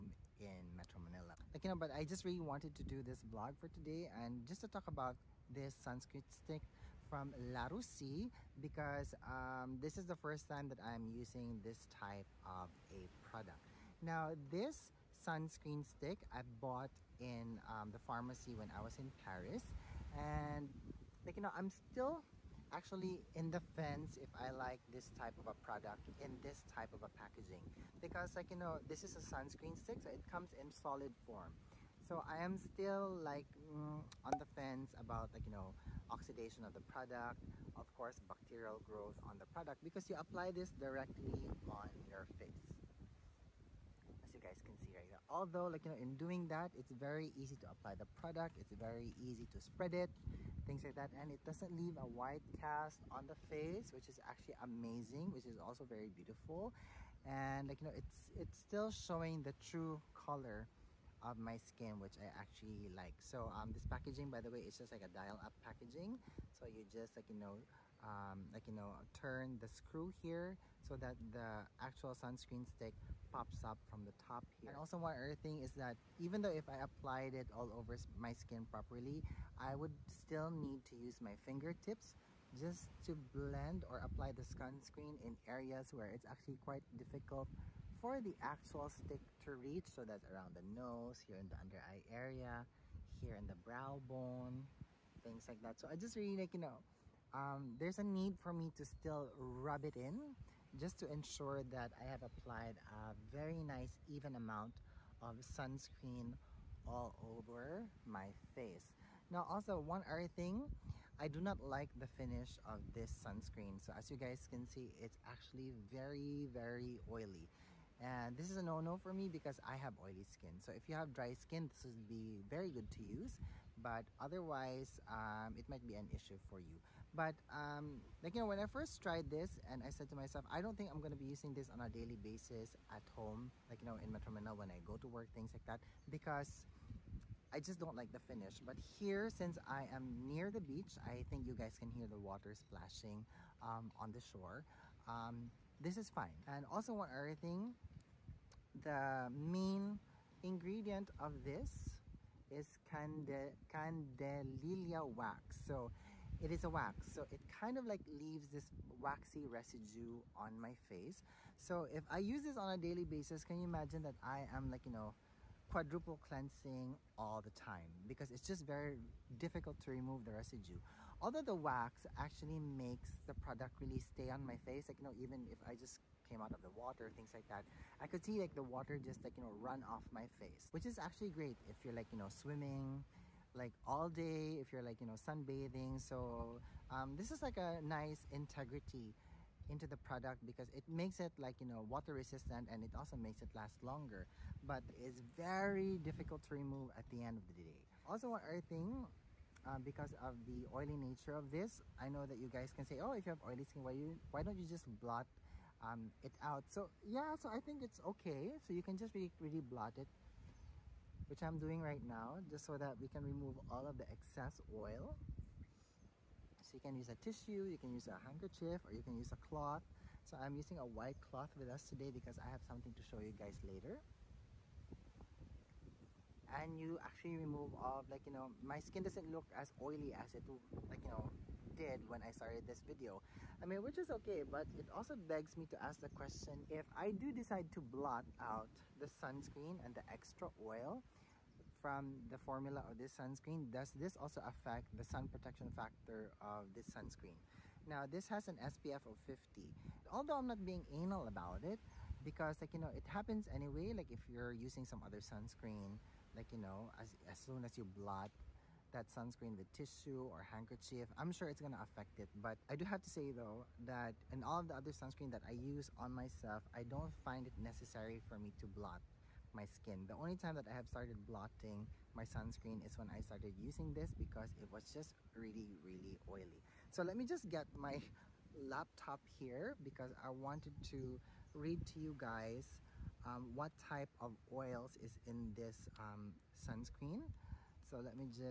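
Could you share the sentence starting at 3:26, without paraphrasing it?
So yeah, so I think it's okay.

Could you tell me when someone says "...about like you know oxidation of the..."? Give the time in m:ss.
0:34.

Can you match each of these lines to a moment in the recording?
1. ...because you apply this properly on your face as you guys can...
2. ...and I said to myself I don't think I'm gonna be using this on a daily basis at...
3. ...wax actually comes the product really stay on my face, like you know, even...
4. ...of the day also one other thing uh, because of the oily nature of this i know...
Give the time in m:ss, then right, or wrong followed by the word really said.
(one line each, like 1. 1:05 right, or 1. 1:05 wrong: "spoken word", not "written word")
1. 0:39 wrong: "directly", not "properly"
2. 2:09 right
3. 2:51 wrong: "makes", not "comes"
4. 3:17 right.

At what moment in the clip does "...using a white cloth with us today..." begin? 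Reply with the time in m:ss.
3:40.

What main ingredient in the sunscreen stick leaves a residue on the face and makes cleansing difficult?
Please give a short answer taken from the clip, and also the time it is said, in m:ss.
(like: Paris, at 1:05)
Candelilla wax, at 2:33.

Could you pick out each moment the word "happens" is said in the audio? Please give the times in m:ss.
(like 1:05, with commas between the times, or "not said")
4:13.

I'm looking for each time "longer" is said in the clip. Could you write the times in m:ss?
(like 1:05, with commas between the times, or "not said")
3:13.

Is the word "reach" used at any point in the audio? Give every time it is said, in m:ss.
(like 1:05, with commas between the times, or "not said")
1:29.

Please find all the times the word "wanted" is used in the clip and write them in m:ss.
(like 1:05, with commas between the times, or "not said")
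0:02, 4:40.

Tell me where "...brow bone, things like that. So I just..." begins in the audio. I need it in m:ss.
1:33.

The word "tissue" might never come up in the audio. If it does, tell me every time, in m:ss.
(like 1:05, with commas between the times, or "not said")
3:37, 4:19.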